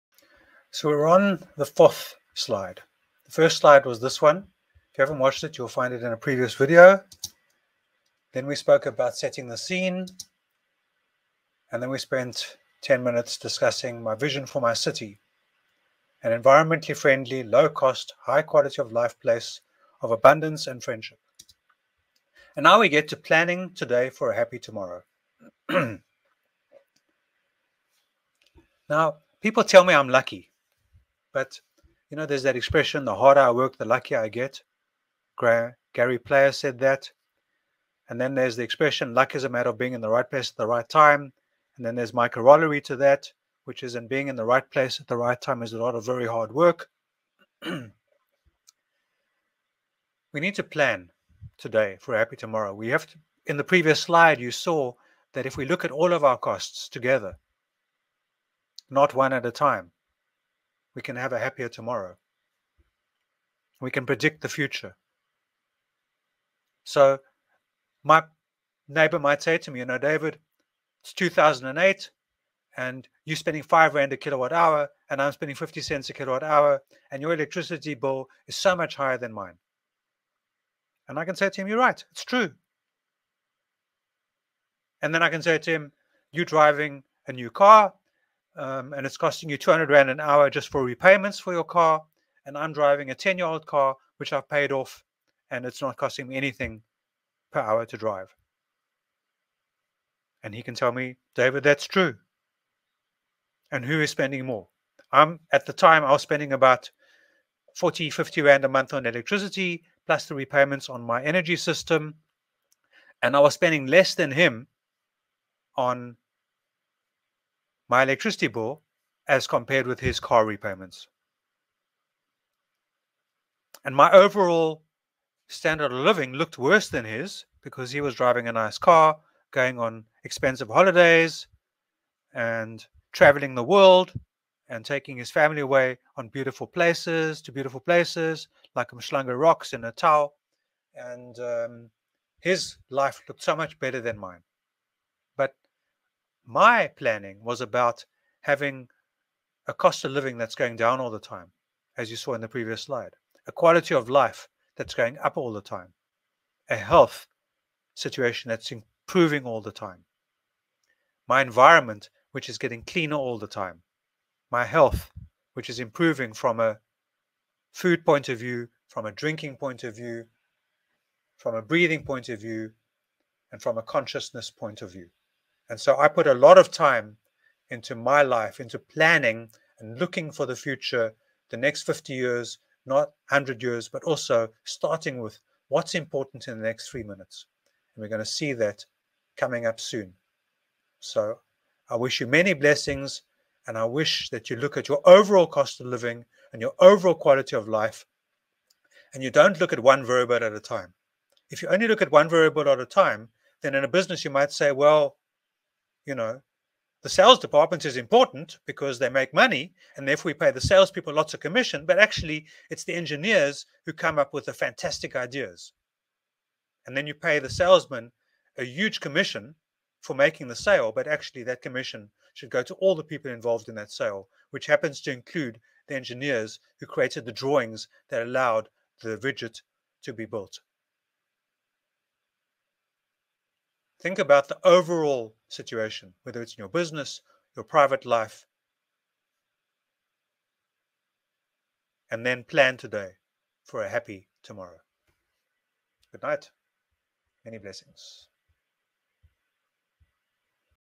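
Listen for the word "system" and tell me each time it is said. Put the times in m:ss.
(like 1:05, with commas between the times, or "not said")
1:51.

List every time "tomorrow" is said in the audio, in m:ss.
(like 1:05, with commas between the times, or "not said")
0:24, 0:52, 1:01, 4:04.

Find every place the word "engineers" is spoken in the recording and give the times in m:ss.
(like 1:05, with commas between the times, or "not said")
3:32, 3:45.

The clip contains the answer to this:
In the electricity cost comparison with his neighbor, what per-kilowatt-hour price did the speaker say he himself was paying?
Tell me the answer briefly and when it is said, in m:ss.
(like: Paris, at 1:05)
5 rand, at 1:13.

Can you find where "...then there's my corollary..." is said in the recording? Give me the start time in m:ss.
0:41.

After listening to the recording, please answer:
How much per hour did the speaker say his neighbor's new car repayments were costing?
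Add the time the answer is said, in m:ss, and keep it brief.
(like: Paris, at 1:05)
200 Rand, at 1:29.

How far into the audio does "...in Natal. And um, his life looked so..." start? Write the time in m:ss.
2:19.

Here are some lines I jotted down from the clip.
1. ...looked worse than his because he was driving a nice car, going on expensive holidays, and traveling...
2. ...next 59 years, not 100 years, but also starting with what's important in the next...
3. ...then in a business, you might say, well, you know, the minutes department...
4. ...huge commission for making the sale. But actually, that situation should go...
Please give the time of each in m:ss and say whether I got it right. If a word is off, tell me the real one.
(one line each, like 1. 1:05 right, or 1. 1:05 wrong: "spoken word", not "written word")
1. 2:06 right
2. 3:01 wrong: "50", not "59"
3. 3:23 wrong: "sales", not "minutes"
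4. 3:38 wrong: "commission", not "situation".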